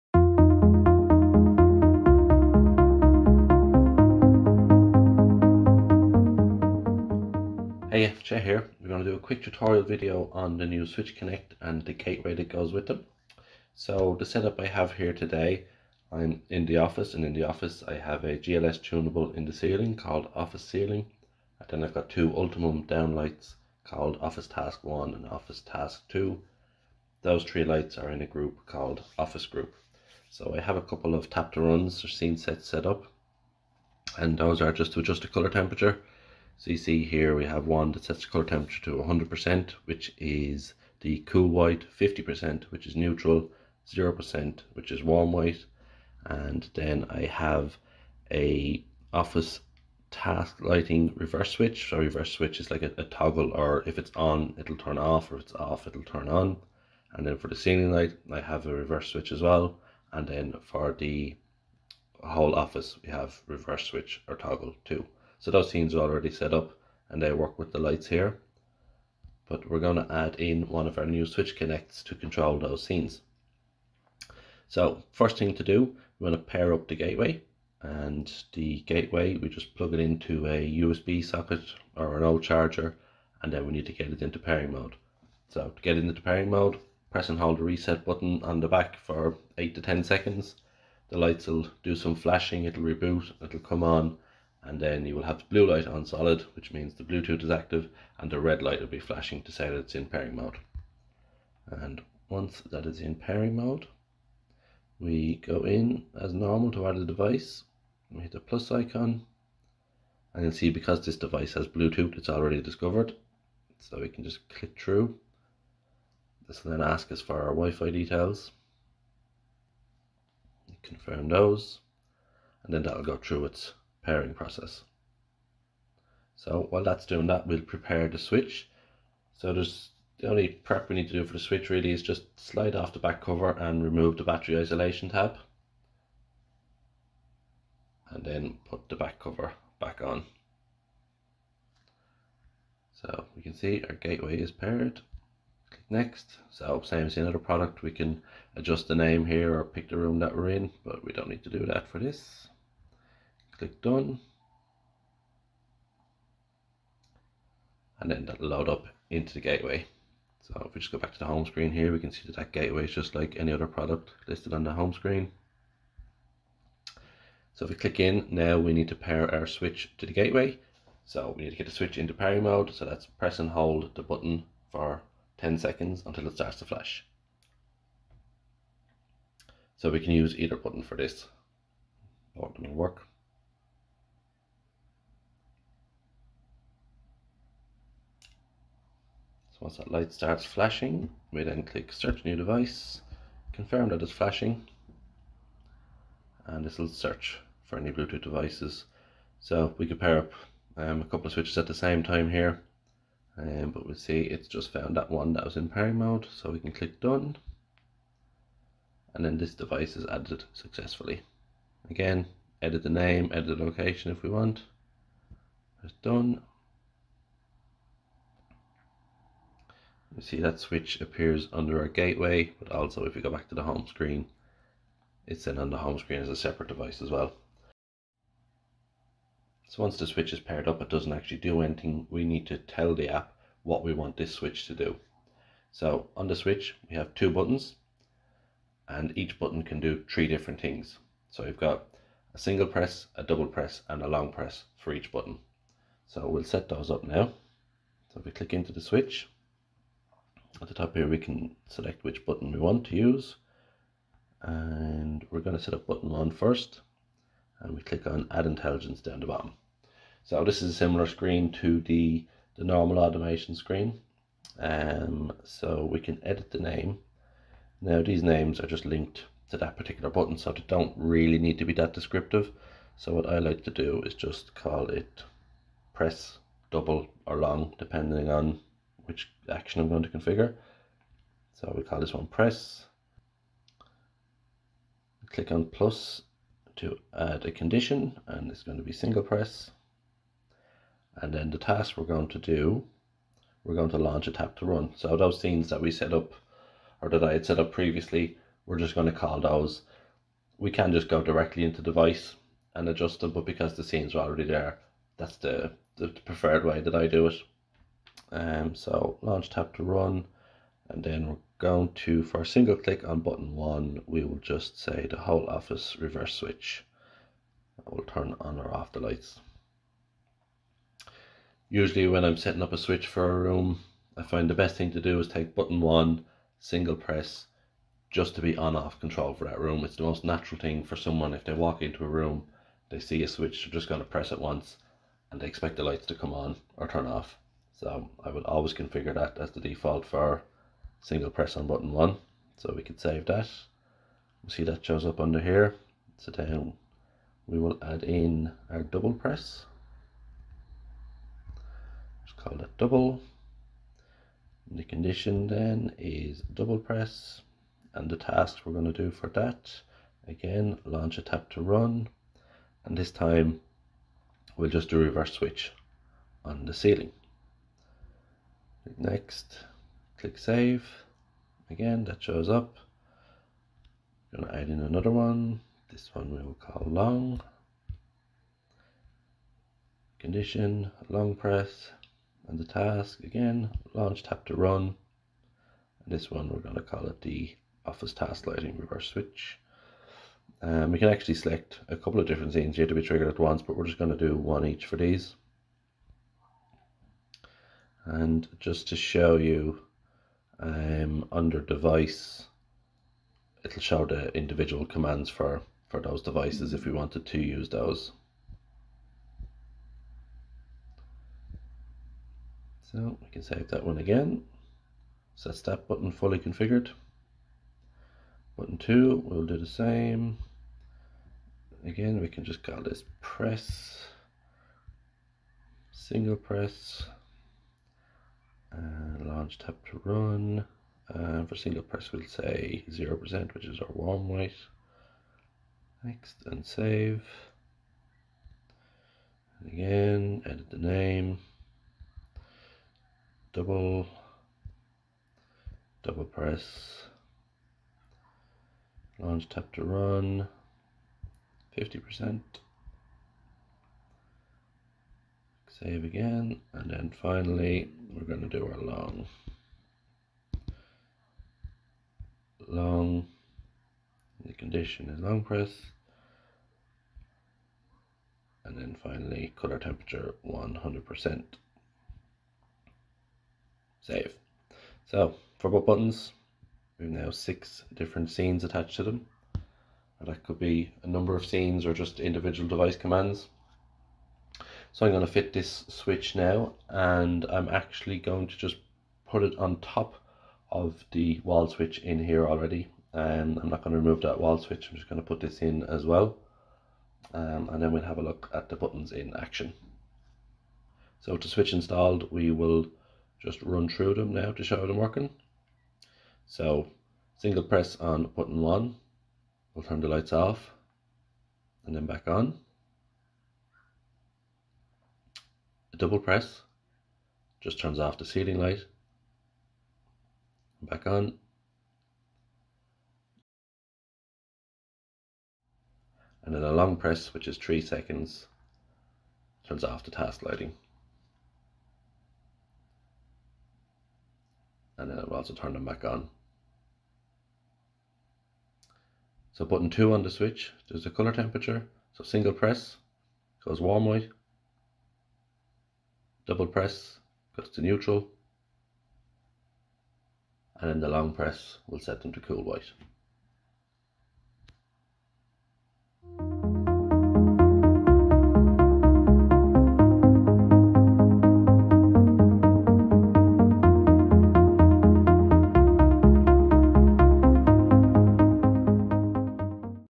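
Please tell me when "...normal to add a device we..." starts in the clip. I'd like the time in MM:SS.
01:46.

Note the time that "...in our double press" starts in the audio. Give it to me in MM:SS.
05:48.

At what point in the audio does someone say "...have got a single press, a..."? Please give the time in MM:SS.
04:01.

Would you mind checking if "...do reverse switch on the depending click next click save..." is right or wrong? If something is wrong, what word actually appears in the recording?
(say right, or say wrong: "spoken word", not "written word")
wrong: "ceiling", not "depending".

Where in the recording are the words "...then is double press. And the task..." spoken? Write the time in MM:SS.
05:55.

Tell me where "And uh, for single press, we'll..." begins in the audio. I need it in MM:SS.
07:11.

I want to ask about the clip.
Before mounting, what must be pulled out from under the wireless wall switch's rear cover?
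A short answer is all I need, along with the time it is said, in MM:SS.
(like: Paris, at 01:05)
Battery isolation tab, at 02:14.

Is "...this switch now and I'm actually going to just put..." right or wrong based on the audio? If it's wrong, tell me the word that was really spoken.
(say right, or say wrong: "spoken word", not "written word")
right.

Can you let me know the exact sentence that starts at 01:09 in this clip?
But we're going to add in one of our new switch connects to control those scenes.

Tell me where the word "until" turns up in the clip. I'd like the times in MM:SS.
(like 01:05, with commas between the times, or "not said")
02:56.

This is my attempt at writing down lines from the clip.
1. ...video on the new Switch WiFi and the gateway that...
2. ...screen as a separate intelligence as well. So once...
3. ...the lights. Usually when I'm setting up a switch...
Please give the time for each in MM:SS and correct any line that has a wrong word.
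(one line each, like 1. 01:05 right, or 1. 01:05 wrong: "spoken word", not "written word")
1. 00:09 wrong: "Connect", not "WiFi"
2. 03:45 wrong: "device", not "intelligence"
3. 05:18 right.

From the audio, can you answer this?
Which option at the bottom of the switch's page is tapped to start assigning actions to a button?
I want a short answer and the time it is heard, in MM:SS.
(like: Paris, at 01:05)
Add intelligence, at 04:18.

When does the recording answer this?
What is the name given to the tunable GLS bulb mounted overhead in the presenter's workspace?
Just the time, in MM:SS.
00:20.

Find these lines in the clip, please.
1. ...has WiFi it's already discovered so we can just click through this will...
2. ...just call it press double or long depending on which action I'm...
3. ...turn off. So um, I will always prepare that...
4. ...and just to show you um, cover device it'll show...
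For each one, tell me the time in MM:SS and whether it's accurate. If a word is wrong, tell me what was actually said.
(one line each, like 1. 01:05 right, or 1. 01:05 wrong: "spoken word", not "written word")
1. 01:51 wrong: "Bluetooth", not "WiFi"
2. 04:34 right
3. 05:36 wrong: "configure", not "prepare"
4. 06:38 wrong: "under", not "cover".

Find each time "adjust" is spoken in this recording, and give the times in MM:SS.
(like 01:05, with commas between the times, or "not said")
00:35, 02:28, 05:02.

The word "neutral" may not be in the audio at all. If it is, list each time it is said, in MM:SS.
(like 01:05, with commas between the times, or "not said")
00:42, 09:07.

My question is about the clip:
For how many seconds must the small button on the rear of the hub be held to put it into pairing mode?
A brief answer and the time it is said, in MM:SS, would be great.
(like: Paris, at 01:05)
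8 to 10 seconds, at 01:29.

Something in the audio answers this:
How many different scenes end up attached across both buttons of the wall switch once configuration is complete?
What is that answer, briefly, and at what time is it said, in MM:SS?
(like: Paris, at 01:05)
6, at 07:57.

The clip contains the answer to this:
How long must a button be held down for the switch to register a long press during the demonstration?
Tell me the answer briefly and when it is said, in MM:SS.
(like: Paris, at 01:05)
3 seconds, at 08:47.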